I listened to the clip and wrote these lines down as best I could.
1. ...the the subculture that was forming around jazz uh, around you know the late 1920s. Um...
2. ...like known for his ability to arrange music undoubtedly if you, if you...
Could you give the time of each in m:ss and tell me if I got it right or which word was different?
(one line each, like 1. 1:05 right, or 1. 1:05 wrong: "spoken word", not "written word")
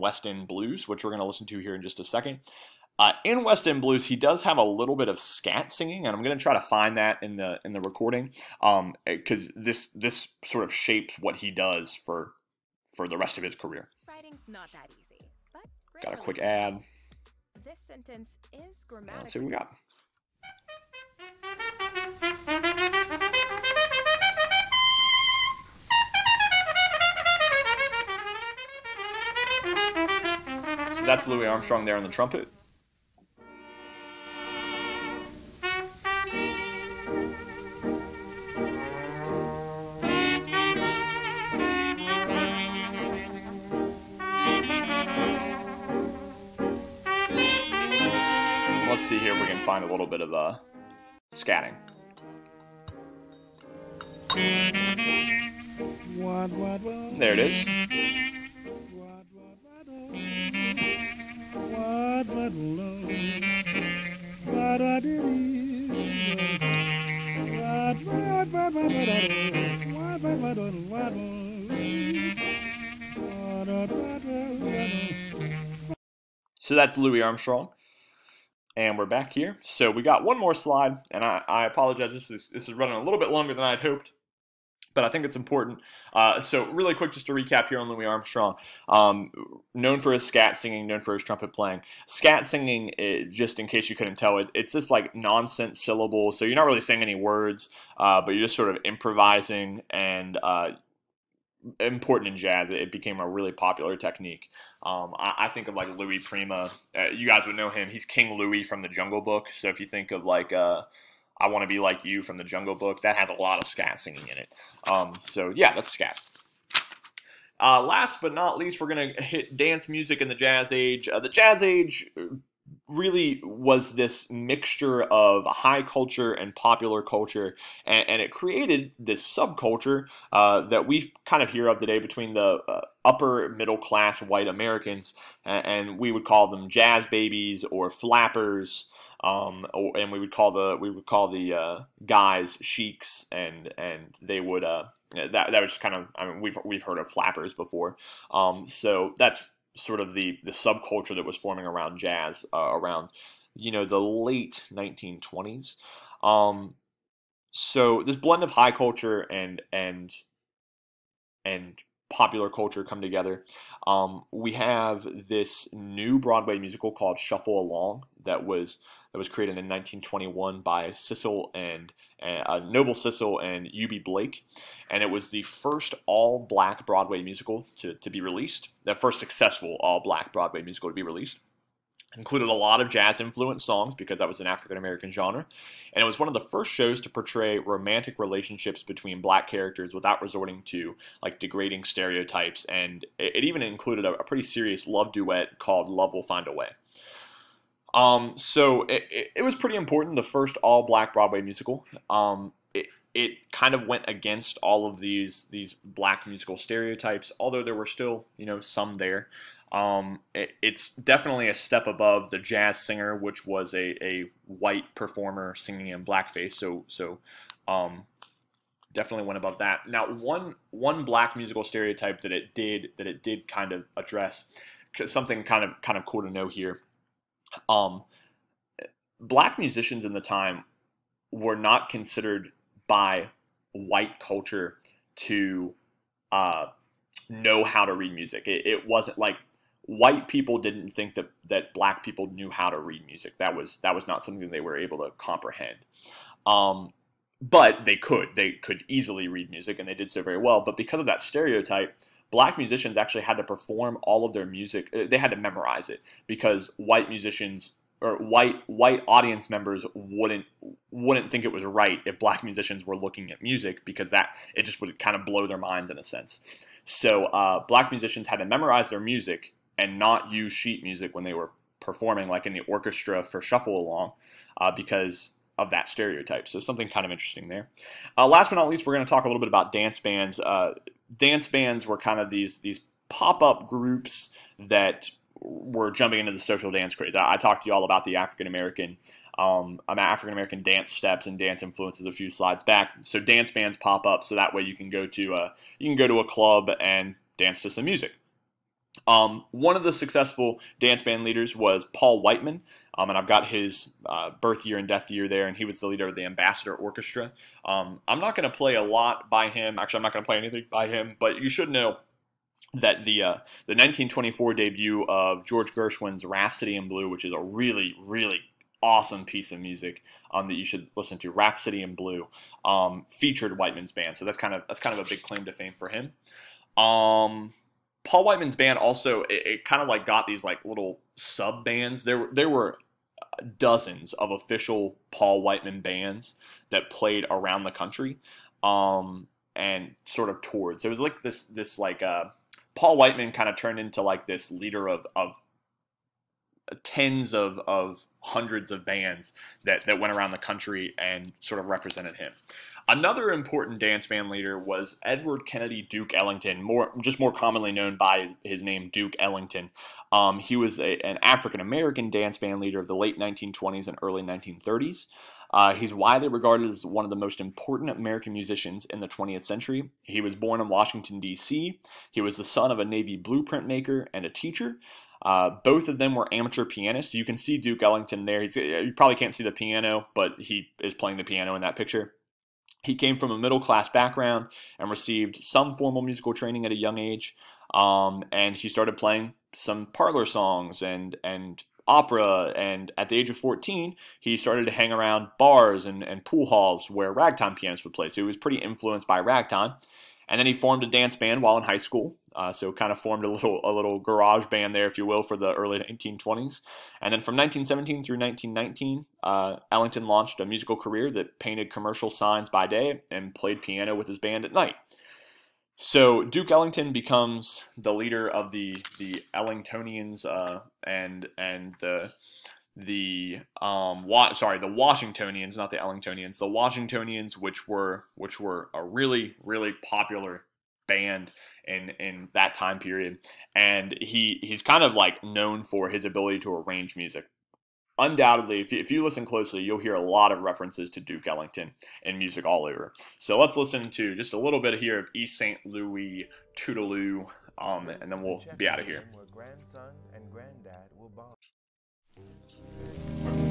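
1. 2:30 right
2. 7:14 right.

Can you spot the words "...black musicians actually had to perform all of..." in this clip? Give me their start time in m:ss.
4:12.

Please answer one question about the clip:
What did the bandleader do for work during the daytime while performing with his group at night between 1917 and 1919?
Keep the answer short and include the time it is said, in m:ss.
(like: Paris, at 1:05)
Painted commercial signs, at 6:51.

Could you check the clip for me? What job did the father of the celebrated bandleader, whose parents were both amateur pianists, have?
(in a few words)
Navy blueprint maker.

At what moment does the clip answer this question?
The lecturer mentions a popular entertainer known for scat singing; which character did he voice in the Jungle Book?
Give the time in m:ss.
1:48.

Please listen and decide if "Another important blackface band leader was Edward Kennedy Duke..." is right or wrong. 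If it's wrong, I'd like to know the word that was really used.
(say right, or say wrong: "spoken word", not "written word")
wrong: "dance", not "blackface".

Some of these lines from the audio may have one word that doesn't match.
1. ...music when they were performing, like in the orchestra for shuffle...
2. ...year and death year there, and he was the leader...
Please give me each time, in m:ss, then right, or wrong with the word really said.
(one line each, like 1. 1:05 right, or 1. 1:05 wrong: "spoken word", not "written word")
1. 4:30 right
2. 5:04 right.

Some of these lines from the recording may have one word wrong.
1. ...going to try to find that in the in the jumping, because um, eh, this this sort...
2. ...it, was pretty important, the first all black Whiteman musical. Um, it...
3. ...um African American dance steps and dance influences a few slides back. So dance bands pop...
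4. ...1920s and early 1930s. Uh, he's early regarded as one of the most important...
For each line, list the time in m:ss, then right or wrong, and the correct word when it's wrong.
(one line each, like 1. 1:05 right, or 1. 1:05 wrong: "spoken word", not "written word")
1. 0:06 wrong: "recording", not "jumping"
2. 3:19 wrong: "Broadway", not "Whiteman"
3. 4:49 right
4. 6:03 wrong: "widely", not "early".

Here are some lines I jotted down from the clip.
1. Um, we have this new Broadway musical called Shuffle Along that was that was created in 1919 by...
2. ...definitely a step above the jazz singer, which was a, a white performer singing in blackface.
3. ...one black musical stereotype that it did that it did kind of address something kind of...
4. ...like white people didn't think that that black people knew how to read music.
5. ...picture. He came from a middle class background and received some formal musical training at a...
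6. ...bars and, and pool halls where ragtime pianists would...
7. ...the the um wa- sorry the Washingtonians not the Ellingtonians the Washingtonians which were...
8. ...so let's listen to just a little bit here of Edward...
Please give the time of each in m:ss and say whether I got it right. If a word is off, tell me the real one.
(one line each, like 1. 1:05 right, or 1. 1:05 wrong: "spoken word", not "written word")
1. 2:43 wrong: "1921", not "1919"
2. 3:30 right
3. 3:40 right
4. 3:59 right
5. 6:21 right
6. 6:35 right
7. 7:01 right
8. 7:23 wrong: "East", not "Edward".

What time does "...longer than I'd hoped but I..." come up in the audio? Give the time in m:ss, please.
1:23.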